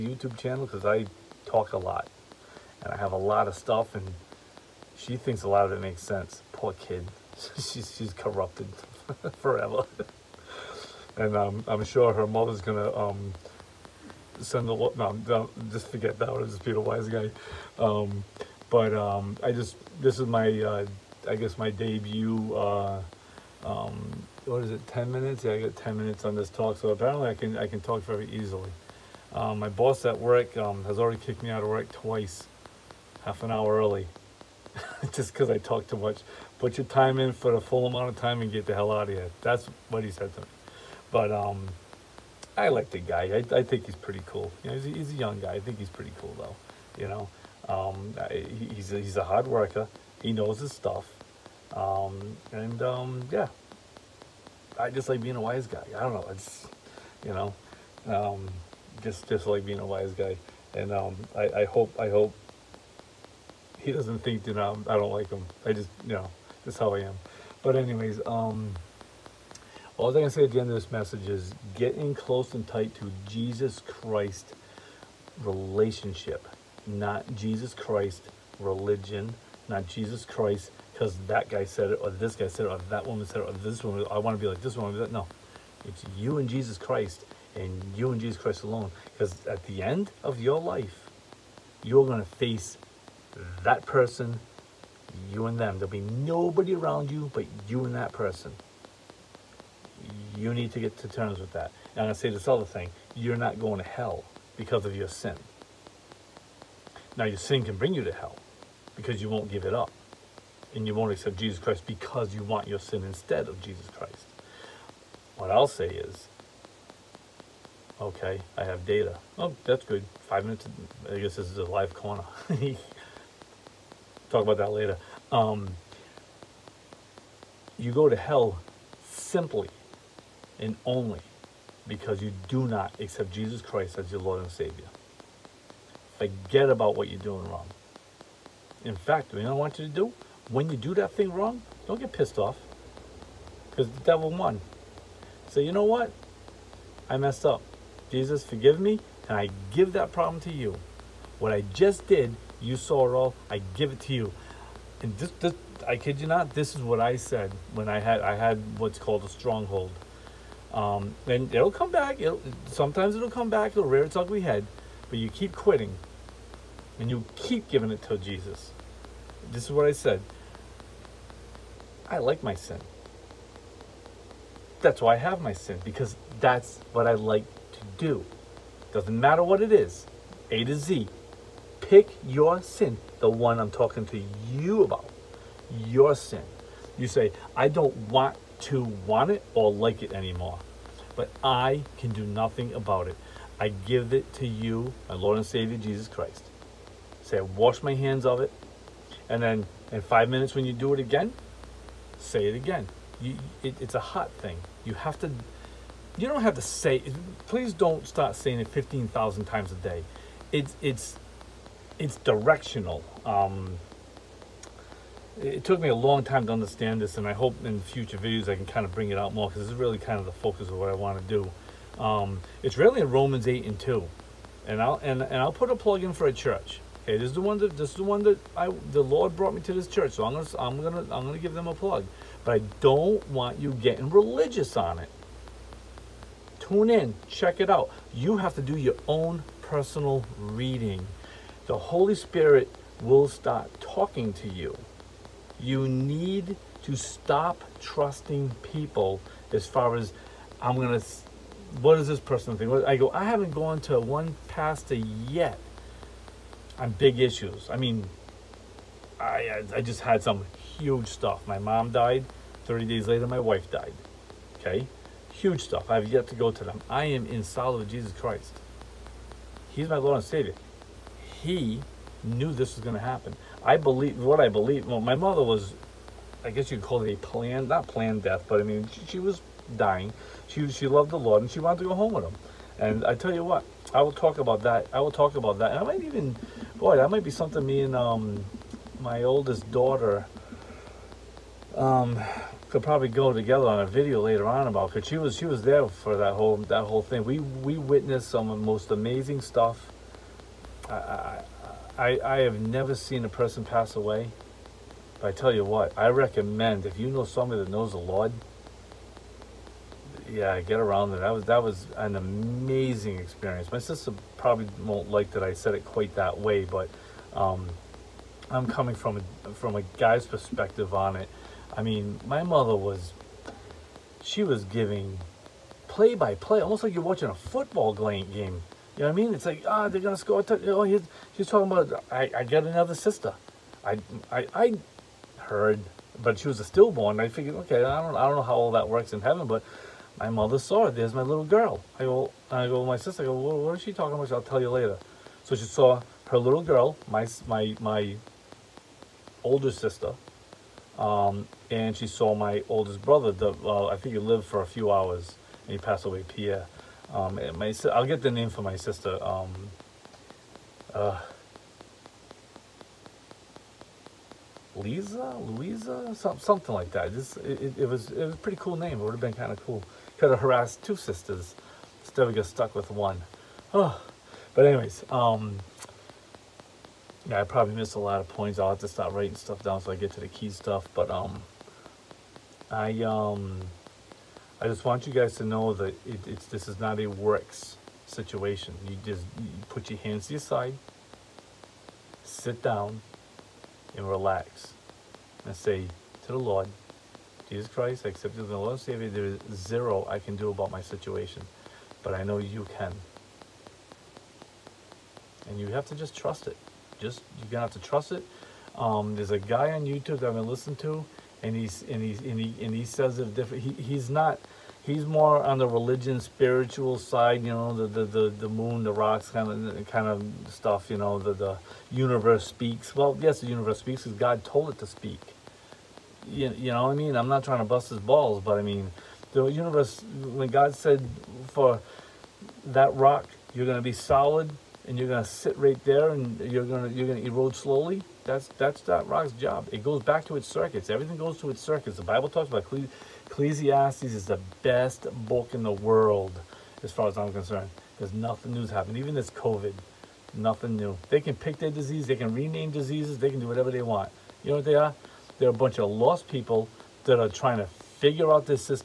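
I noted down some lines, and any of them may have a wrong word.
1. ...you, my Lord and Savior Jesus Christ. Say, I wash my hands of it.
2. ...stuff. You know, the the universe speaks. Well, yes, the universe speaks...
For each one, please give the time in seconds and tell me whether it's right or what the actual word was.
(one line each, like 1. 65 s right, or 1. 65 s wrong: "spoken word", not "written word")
1. 194 s right
2. 420 s right.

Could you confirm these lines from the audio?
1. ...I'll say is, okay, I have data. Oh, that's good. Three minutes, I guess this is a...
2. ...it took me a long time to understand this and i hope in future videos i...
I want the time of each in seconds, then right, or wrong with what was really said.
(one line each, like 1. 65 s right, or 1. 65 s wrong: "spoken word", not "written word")
1. 115 s wrong: "Five", not "Three"
2. 215 s right.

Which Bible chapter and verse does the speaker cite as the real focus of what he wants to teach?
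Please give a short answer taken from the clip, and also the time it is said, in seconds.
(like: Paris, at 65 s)
Romans 8:2, at 223 s.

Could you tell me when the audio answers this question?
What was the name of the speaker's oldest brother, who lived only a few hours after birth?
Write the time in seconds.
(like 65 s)
356 s.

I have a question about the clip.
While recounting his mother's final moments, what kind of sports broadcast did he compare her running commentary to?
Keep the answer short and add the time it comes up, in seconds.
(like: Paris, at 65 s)
football game, at 327 s.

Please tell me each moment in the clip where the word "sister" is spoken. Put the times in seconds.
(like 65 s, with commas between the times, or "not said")
313 s, 332 s, 342 s, 349 s, 358 s, 370 s.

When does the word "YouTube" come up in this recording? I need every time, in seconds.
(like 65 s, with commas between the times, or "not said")
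0 s, 409 s.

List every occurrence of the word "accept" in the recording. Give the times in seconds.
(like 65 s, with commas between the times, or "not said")
111 s, 132 s, 398 s.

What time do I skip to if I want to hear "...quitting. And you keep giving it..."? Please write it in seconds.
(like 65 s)
165 s.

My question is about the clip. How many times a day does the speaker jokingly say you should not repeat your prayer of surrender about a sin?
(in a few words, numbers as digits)
15,000.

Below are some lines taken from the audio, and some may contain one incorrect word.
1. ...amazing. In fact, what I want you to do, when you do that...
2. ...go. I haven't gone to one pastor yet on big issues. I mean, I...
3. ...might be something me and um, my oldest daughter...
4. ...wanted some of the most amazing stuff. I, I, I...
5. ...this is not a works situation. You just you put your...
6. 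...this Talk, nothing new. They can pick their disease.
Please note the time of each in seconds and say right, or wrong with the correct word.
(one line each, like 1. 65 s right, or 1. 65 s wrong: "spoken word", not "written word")
1. 137 s wrong: "wrong", not "amazing"
2. 252 s right
3. 287 s right
4. 297 s wrong: "witnessed", not "wanted"
5. 386 s right
6. 449 s wrong: "COVID", not "Talk".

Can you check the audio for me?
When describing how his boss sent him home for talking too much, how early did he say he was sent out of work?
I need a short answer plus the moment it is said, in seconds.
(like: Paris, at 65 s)
half an hour early, at 33 s.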